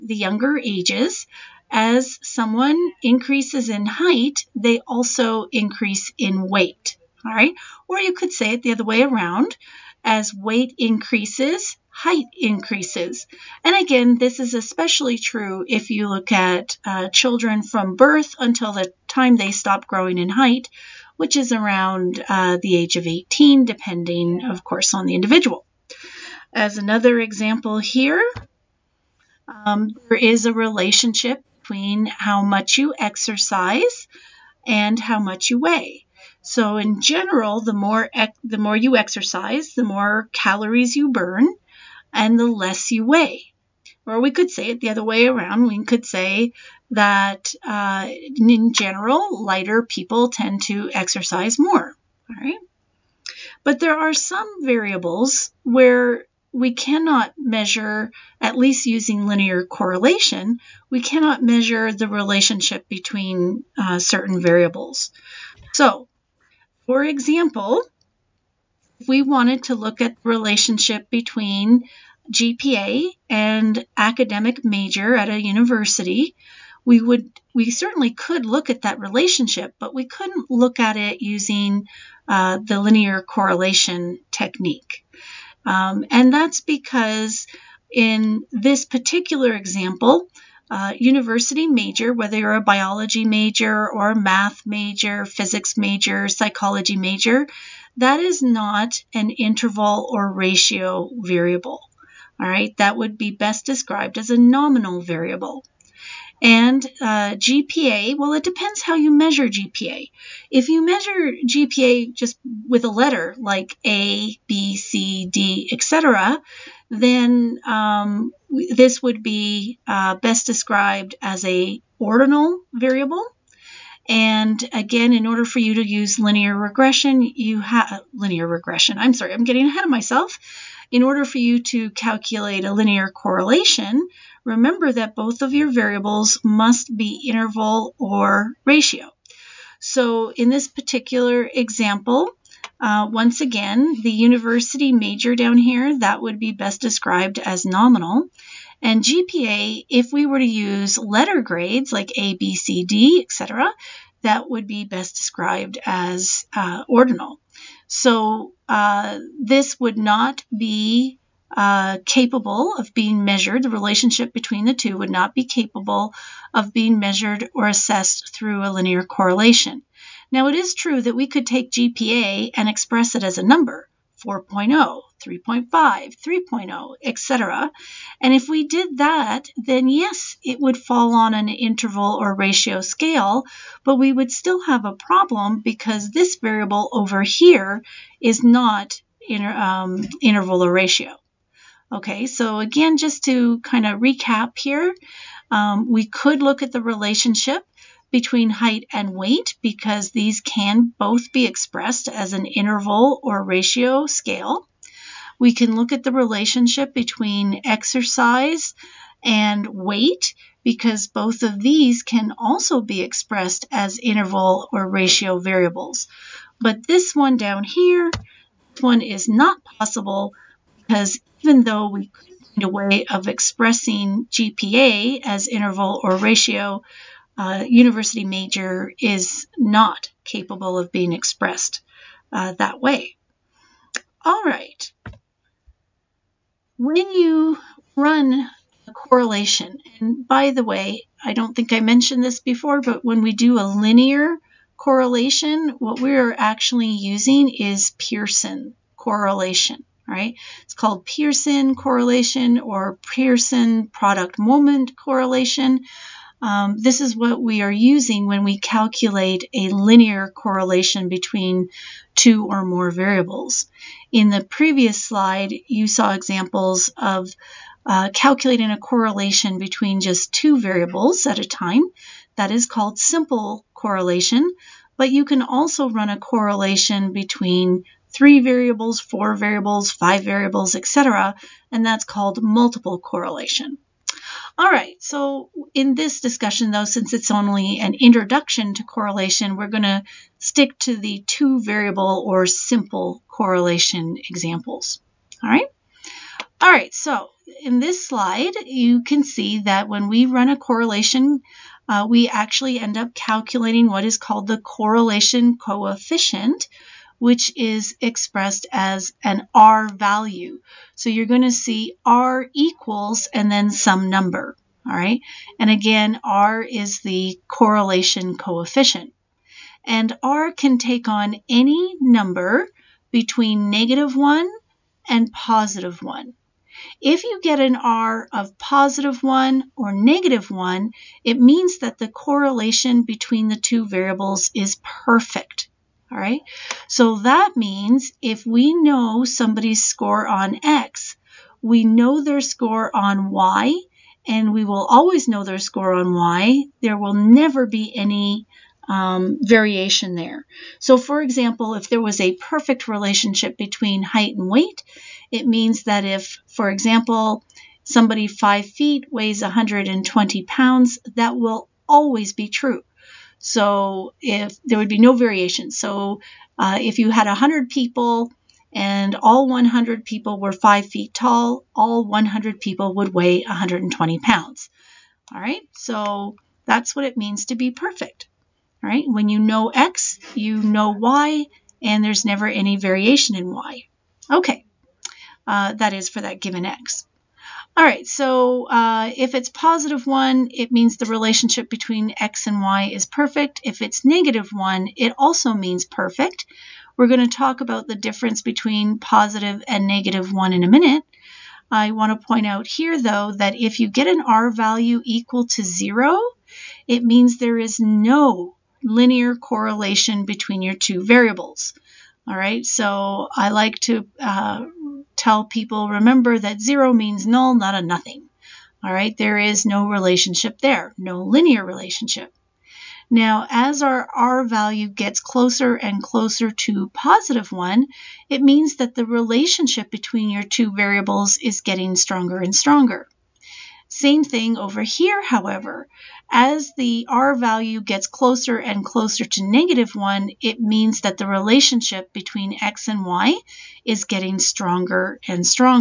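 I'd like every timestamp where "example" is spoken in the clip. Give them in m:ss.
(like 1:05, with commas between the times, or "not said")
0:27, 1:07, 1:29, 2:21, 4:26, 4:54, 5:51, 5:56.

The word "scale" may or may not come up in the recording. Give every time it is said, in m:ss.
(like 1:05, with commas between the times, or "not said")
3:02, 3:24.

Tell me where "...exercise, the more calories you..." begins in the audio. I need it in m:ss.
0:38.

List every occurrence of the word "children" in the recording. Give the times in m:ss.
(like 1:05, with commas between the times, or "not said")
0:17.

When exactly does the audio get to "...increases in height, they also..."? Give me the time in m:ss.
0:03.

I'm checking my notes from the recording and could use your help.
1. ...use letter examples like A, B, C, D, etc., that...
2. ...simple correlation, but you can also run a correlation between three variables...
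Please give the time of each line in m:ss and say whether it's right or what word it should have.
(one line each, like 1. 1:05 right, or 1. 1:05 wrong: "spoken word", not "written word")
1. 2:30 wrong: "grades", not "examples"
2. 4:32 right.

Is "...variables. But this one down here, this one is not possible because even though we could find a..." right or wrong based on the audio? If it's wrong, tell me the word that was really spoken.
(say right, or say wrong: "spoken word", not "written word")
right.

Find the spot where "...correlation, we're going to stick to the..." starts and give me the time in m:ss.
4:48.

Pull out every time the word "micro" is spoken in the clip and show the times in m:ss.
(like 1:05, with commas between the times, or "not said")
not said.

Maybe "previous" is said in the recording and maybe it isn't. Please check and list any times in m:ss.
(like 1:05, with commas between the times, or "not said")
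4:24.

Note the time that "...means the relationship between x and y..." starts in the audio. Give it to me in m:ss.
6:30.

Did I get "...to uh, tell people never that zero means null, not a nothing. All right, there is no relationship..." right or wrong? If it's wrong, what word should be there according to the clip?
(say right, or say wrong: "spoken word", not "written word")
wrong: "remember", not "never".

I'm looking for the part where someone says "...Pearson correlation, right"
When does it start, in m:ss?
4:07.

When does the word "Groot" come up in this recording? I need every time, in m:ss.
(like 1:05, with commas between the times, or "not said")
not said.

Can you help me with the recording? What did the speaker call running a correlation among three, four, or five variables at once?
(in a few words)
multiple correlation.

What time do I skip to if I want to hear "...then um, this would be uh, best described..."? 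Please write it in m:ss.
1:56.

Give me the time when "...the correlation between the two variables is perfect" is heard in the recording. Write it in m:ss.
5:31.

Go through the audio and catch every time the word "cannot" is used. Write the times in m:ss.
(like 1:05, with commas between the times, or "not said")
0:56, 1:01.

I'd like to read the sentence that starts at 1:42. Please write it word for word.
All right, that would be best described as a nominal variable.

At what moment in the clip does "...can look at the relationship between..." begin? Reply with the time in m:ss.
3:25.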